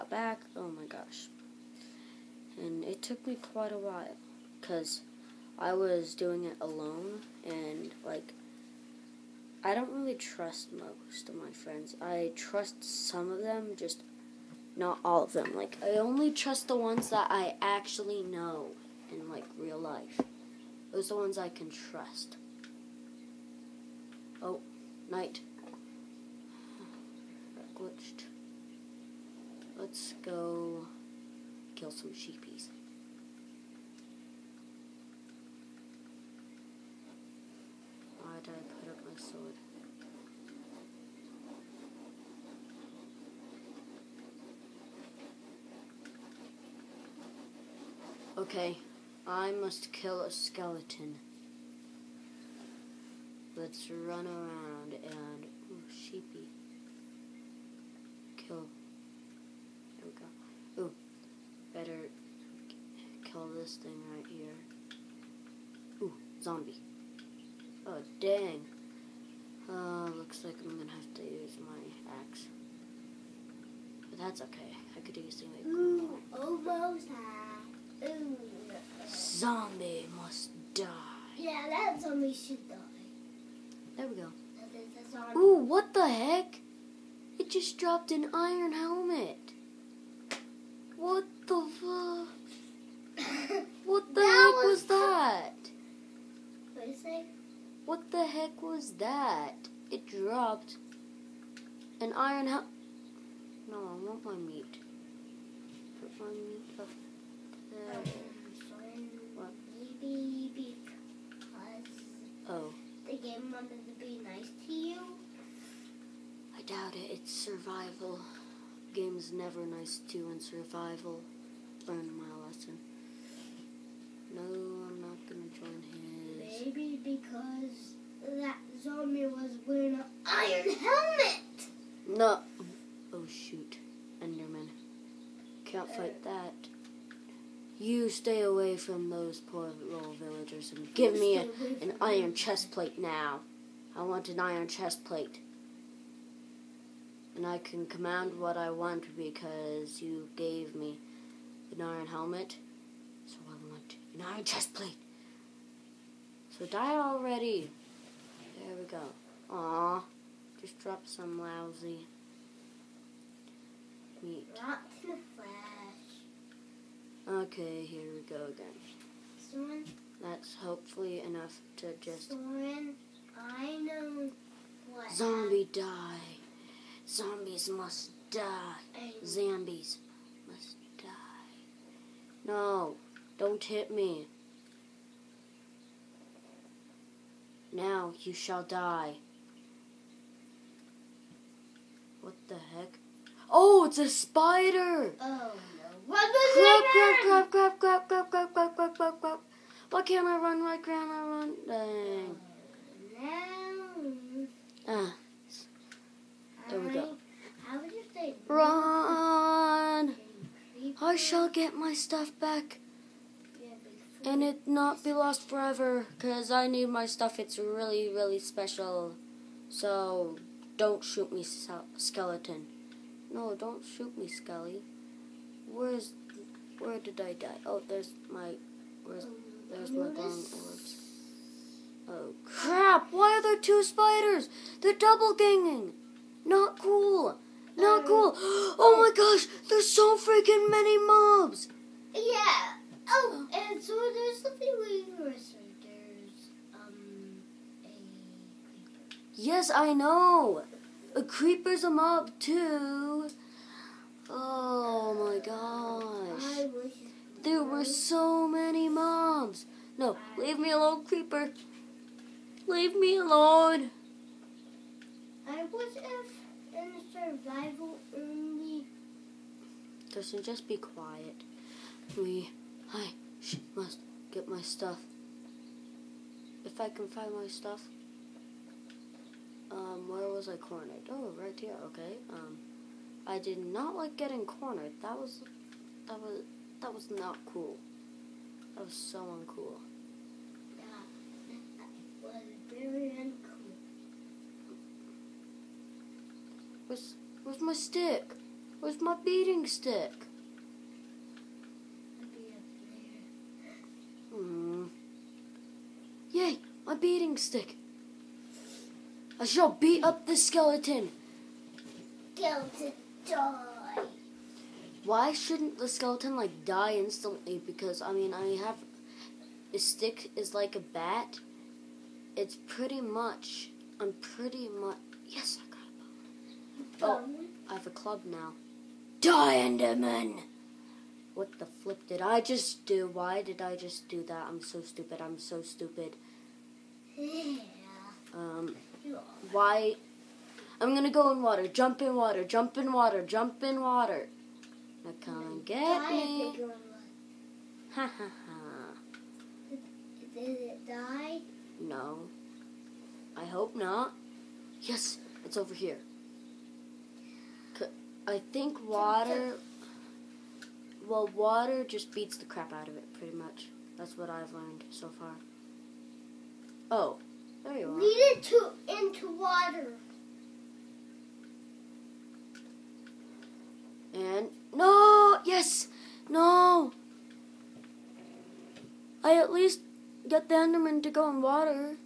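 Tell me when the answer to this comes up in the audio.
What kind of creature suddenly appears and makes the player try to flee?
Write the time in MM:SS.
03:14.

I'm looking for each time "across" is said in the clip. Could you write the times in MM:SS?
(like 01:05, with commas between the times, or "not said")
not said.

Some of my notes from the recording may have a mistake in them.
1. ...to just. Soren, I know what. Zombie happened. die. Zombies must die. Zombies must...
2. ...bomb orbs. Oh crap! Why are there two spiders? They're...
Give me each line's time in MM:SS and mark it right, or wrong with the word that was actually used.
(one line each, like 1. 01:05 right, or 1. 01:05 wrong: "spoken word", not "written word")
1. 02:51 right
2. 03:50 right.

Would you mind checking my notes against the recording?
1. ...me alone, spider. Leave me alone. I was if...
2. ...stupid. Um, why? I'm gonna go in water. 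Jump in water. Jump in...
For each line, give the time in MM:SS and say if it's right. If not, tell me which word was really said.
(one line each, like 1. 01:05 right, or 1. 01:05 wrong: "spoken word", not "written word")
1. 04:20 wrong: "creeper", not "spider"
2. 05:35 right.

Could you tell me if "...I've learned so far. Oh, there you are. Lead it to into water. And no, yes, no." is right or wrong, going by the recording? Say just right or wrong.
right.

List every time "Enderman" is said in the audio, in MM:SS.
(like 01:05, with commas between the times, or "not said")
02:14, 05:29, 06:20.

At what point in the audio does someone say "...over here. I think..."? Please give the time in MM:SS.
05:55.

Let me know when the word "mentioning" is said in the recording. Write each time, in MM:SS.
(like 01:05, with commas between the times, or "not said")
not said.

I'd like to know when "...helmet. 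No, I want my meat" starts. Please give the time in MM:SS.
01:42.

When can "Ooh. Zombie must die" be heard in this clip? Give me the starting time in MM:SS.
01:18.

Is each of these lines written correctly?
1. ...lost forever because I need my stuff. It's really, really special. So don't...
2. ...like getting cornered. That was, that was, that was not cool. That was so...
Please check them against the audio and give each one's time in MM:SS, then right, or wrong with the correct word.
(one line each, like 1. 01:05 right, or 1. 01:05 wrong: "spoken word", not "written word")
1. 03:35 right
2. 04:43 right.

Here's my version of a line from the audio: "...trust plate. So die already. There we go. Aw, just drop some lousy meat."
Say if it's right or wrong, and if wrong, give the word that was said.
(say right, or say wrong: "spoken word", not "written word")
wrong: "chest", not "trust".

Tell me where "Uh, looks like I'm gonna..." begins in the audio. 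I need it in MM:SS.
01:09.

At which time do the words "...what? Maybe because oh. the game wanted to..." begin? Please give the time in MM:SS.
01:49.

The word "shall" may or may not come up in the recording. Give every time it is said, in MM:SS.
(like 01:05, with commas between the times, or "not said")
03:08, 03:31, 05:09.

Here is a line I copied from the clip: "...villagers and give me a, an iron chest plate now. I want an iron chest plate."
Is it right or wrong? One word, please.
right.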